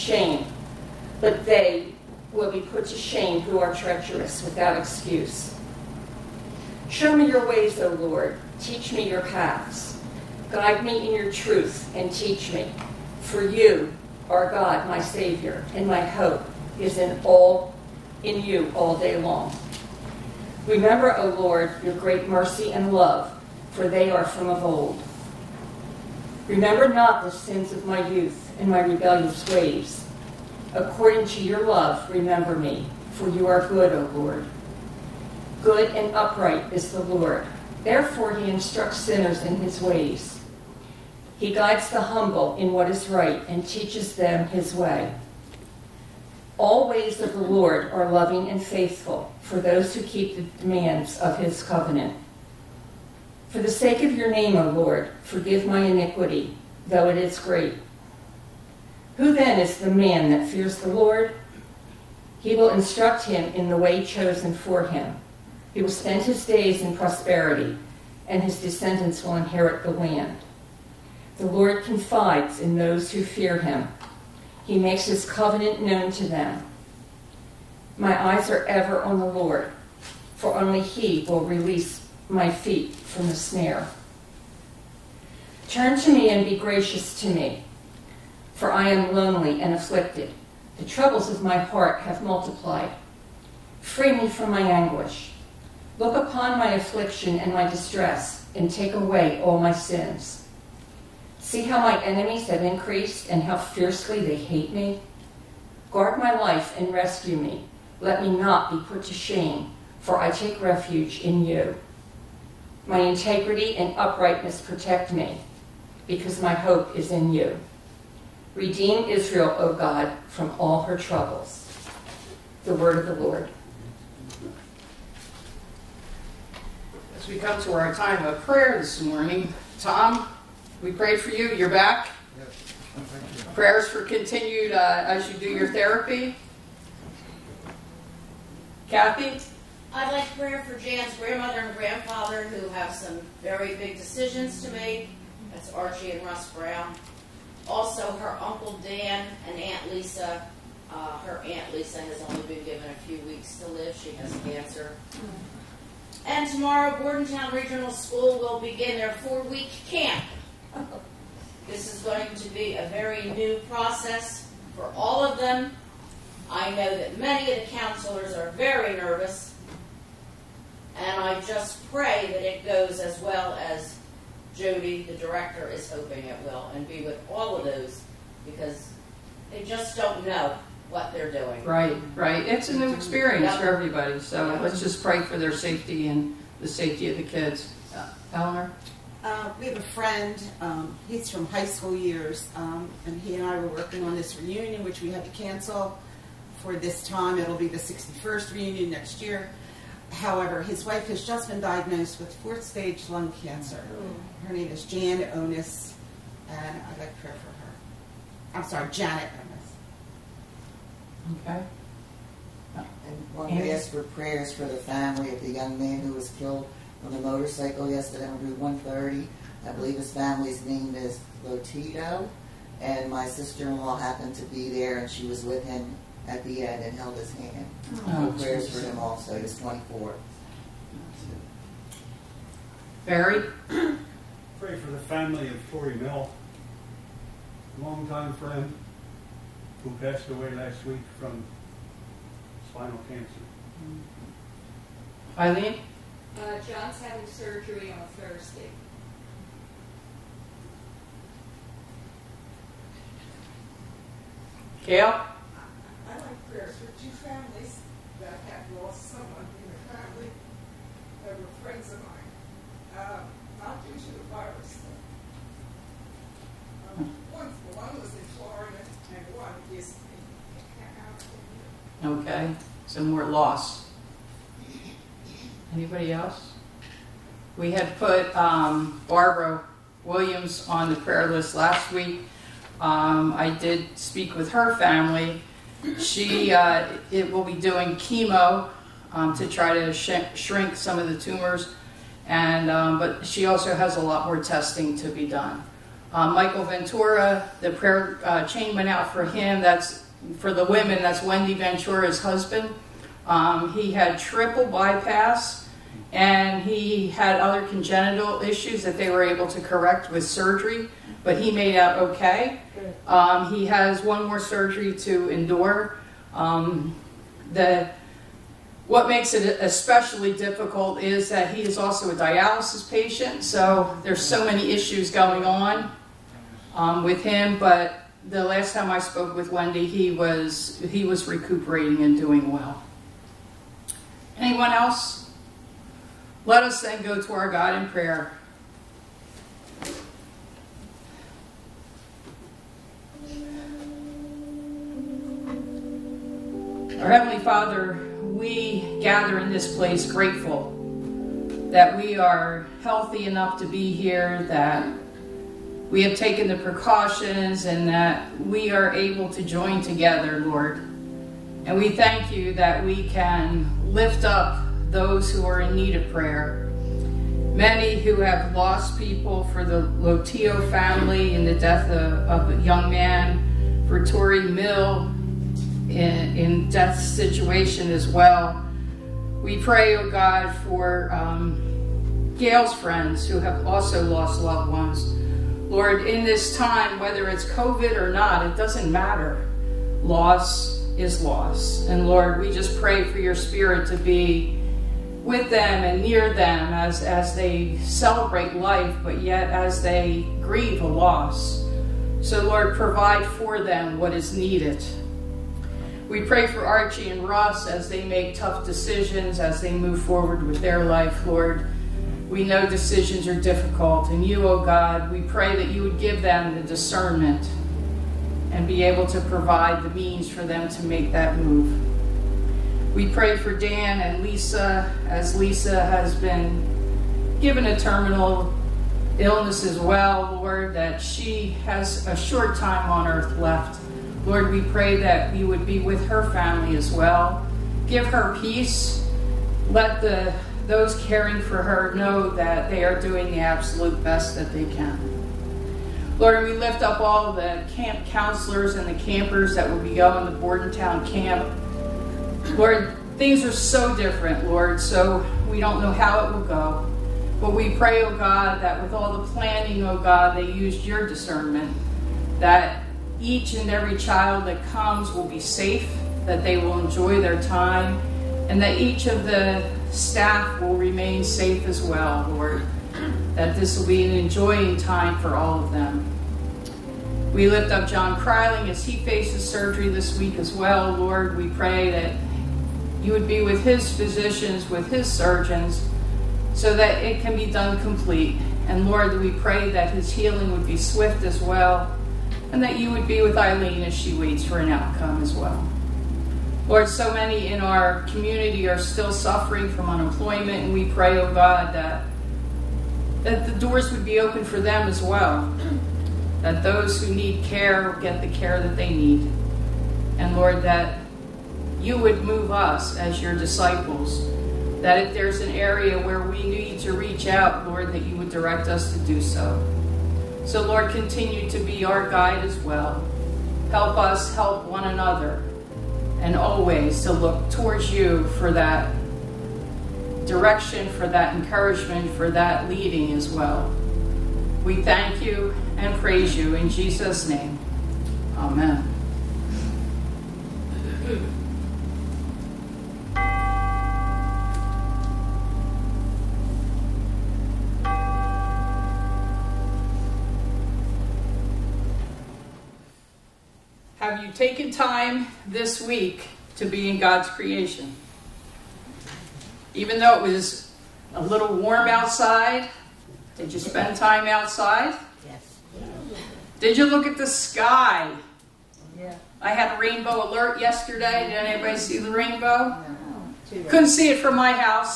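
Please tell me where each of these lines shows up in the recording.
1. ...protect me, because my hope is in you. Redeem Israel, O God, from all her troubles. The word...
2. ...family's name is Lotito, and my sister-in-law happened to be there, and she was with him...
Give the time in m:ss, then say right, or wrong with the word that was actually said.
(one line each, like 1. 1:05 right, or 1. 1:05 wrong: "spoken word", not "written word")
1. 1:54 right
2. 3:40 right.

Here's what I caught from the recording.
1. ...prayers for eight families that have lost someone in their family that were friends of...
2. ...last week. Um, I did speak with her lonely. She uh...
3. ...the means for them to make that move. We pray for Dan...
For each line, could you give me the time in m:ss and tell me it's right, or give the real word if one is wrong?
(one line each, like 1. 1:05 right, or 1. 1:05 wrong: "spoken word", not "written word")
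1. 4:16 wrong: "two", not "eight"
2. 4:41 wrong: "family", not "lonely"
3. 6:59 right.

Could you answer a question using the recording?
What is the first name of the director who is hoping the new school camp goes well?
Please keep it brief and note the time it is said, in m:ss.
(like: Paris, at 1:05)
Jody, at 2:54.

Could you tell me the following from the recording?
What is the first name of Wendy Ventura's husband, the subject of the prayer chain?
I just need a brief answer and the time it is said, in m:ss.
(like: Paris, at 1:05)
Michael, at 4:56.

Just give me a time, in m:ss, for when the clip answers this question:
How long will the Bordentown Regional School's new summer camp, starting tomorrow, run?
2:39.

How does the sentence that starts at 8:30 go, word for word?
And Lord, that you would move us as your disciples.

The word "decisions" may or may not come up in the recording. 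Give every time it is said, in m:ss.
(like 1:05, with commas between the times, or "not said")
2:23, 6:48, 6:52.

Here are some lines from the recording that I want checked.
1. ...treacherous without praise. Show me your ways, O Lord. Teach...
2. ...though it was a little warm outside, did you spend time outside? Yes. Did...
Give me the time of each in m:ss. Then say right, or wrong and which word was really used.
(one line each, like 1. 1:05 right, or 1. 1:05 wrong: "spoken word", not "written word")
1. 0:03 wrong: "excuse", not "praise"
2. 9:19 right.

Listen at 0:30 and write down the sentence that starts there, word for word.
According to your love, remember me, for you are good, O Lord.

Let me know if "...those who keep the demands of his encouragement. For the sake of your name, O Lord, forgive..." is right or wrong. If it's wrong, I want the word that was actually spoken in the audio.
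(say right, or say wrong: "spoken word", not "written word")
wrong: "covenant", not "encouragement".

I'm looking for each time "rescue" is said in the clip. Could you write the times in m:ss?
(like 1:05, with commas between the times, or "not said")
1:46.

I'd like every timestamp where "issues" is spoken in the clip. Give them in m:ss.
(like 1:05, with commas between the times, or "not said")
5:08, 5:24.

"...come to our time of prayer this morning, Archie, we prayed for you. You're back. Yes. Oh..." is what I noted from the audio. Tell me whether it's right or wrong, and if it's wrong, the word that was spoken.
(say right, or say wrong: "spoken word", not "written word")
wrong: "Tom", not "Archie".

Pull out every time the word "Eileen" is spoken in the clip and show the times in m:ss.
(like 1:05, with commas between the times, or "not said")
4:05, 8:13.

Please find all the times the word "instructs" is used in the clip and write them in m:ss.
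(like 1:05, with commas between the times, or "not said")
0:38, 1:02.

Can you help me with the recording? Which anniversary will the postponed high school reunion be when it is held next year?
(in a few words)
61st.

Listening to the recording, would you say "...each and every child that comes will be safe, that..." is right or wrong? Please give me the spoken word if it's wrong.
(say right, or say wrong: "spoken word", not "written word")
right.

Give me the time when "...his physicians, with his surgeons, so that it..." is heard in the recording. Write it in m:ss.
8:03.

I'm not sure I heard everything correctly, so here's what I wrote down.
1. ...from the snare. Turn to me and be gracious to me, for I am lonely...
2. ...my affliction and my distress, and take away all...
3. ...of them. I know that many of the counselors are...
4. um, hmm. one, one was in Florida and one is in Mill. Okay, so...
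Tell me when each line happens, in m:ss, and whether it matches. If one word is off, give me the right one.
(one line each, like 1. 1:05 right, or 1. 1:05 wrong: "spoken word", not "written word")
1. 1:22 right
2. 1:36 right
3. 2:45 right
4. 4:26 wrong: "California", not "Mill".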